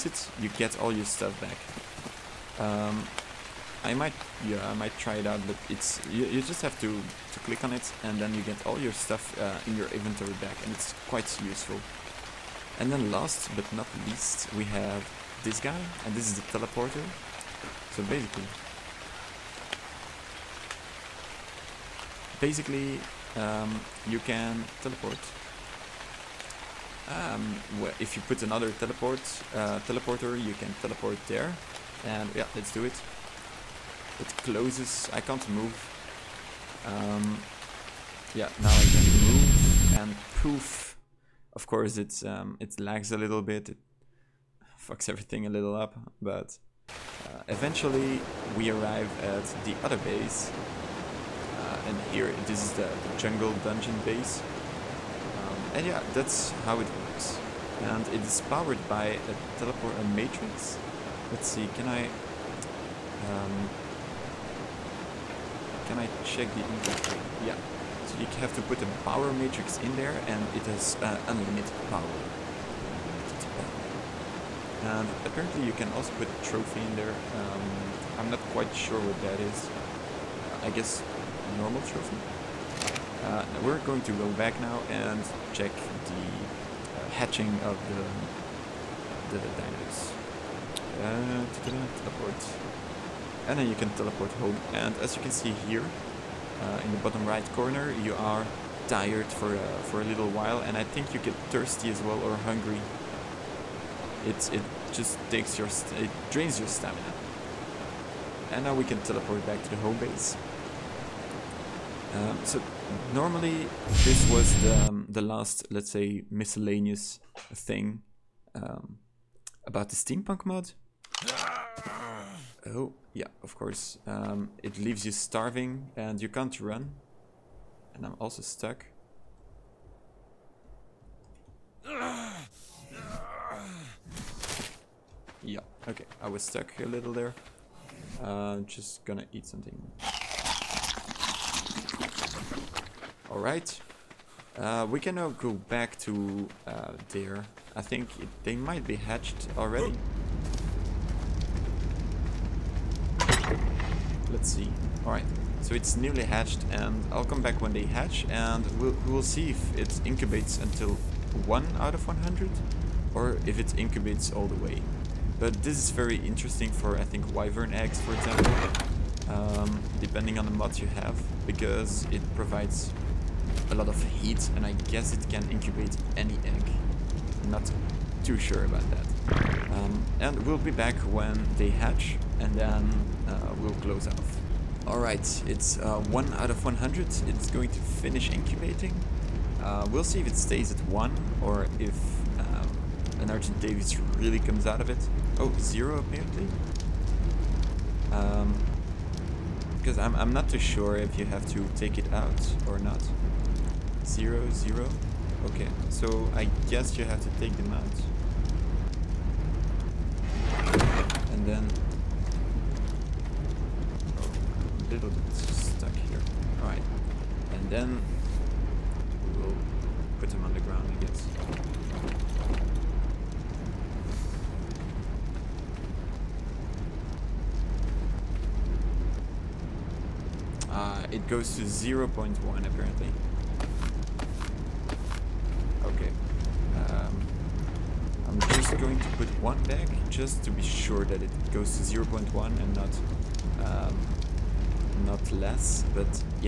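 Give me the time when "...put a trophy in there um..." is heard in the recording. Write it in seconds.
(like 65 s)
76 s.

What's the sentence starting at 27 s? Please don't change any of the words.
Um, if you put another teleport uh, teleporter, you can teleport there.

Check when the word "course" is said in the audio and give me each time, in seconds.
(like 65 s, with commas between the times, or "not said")
41 s, 123 s.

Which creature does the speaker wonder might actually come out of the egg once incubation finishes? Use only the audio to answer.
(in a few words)
Argentavis.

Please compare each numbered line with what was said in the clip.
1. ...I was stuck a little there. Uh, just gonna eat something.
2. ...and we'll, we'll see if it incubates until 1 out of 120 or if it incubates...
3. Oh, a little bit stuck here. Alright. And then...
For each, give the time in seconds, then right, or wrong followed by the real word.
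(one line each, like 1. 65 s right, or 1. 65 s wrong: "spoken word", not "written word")
1. 136 s right
2. 158 s wrong: "100", not "120"
3. 214 s right.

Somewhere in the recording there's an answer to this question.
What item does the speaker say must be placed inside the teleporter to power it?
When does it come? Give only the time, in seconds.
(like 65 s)
69 s.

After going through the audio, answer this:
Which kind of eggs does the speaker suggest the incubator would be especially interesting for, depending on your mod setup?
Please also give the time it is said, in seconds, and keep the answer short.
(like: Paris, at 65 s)
wyvern eggs, at 167 s.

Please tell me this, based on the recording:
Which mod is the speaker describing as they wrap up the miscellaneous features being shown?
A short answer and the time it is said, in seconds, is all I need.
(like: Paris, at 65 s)
steampunk mod, at 119 s.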